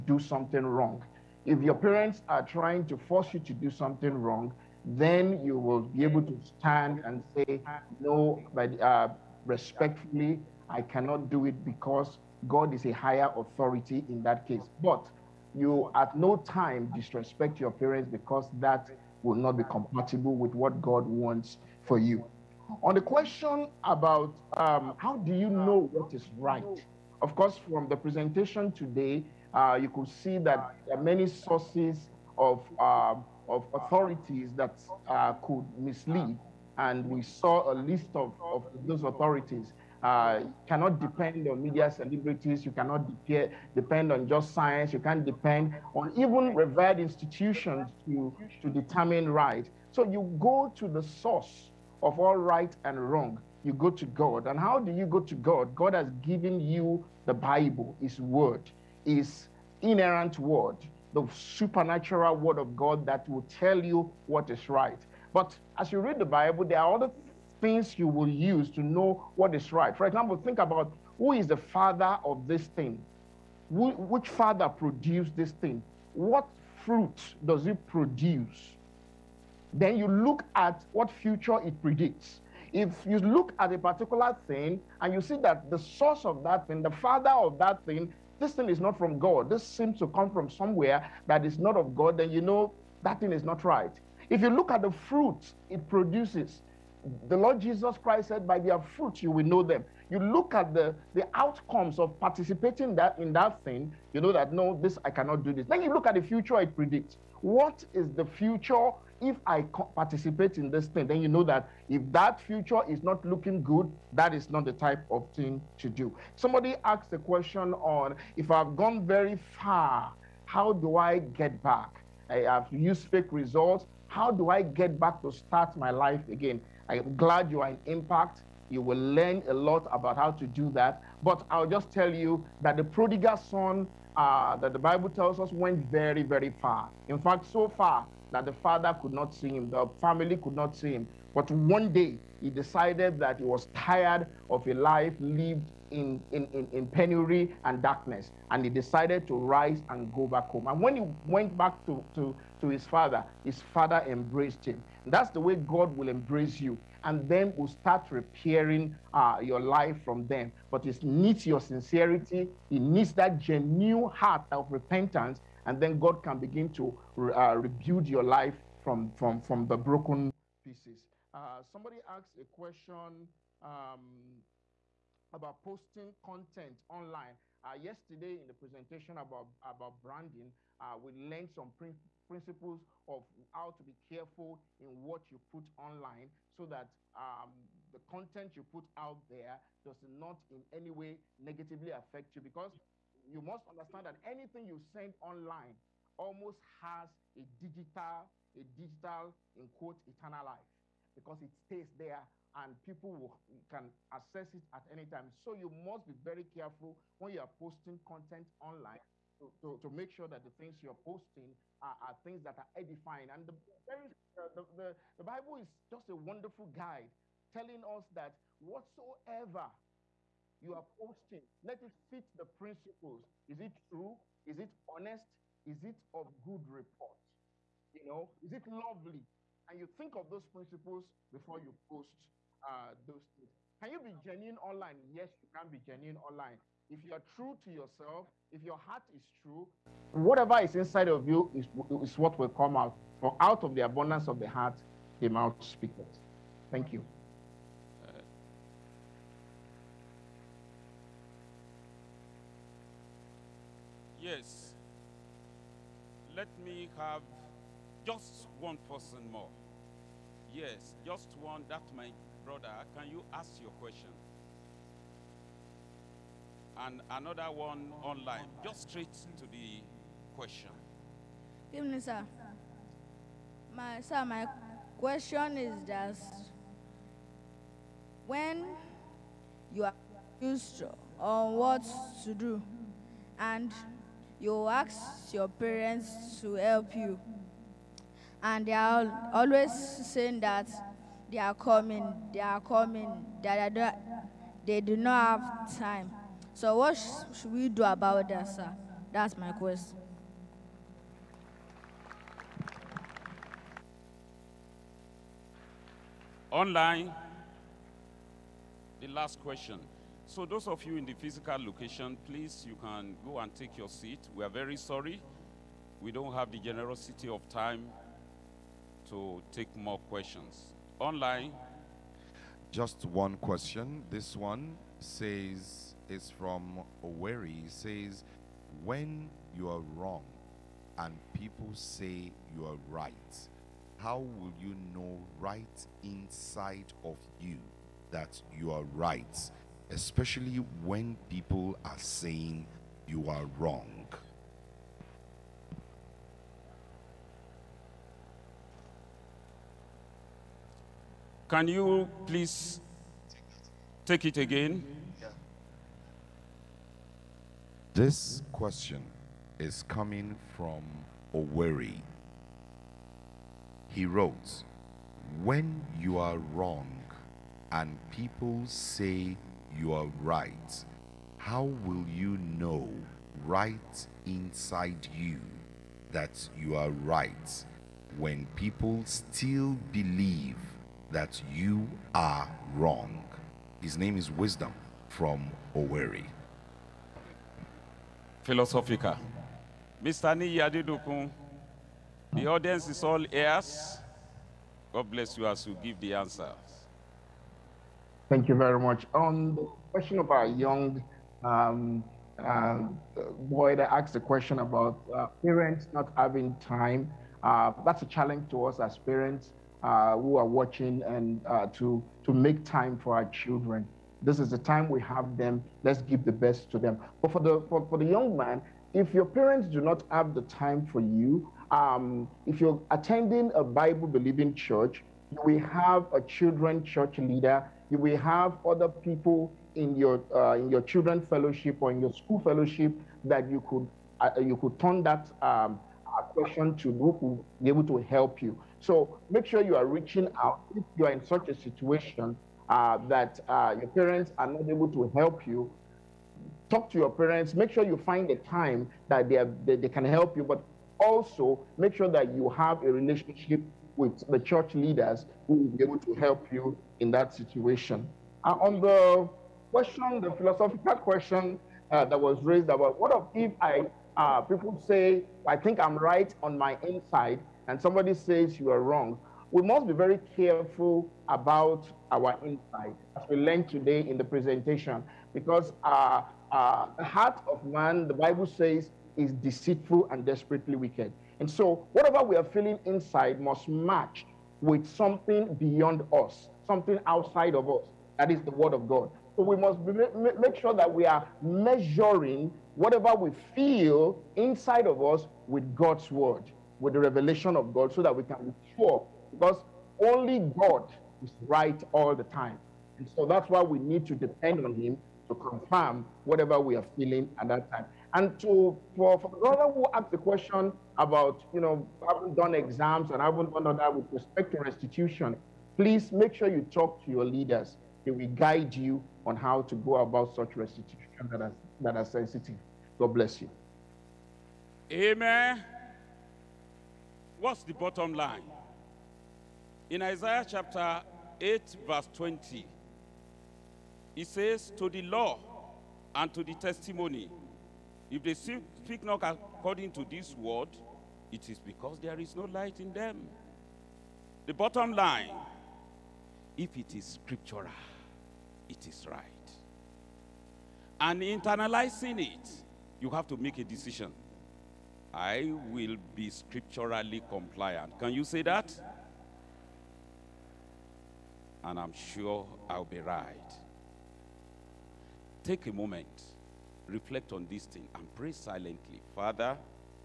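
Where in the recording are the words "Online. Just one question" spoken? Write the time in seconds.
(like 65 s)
320 s.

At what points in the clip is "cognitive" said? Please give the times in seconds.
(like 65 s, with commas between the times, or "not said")
not said.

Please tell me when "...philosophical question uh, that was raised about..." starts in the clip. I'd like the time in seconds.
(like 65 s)
460 s.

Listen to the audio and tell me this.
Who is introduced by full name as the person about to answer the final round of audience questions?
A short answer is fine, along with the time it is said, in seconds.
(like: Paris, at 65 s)
Niyi Adedokun, at 390 s.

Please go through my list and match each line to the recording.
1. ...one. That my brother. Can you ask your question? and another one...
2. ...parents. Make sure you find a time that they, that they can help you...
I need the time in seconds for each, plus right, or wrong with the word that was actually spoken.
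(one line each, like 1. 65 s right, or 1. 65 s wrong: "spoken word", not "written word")
1. 261 s right
2. 447 s right.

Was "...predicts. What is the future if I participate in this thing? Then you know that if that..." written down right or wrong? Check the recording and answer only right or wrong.
right.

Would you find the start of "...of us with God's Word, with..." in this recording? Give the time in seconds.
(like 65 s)
494 s.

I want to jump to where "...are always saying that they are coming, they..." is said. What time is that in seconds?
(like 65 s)
288 s.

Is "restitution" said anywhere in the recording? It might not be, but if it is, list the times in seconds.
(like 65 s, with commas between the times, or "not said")
514 s, 520 s.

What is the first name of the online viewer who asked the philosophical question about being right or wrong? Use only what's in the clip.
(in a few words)
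Wisdom.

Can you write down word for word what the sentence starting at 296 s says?
So what sh should we do about that, sir?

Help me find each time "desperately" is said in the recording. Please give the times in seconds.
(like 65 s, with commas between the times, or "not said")
480 s.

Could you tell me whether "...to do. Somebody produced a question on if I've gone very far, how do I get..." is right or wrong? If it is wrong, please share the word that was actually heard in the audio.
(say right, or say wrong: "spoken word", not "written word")
wrong: "asked", not "produced".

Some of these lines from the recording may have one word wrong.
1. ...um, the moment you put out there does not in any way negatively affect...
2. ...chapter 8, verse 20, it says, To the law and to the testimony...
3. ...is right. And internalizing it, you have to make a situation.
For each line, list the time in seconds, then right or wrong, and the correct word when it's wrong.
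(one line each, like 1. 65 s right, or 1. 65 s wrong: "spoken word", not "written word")
1. 187 s wrong: "content", not "moment"
2. 530 s right
3. 548 s wrong: "decision", not "situation".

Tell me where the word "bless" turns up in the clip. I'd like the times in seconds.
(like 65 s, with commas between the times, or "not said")
395 s, 523 s.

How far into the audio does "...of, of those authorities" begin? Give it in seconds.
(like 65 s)
38 s.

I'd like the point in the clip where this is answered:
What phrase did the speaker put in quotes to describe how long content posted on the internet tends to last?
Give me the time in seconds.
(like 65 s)
200 s.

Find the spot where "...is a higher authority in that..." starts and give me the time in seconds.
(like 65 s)
12 s.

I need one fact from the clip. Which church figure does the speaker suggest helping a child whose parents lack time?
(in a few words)
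Children church leader.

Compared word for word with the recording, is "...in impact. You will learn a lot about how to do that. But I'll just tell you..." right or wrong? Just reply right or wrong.
right.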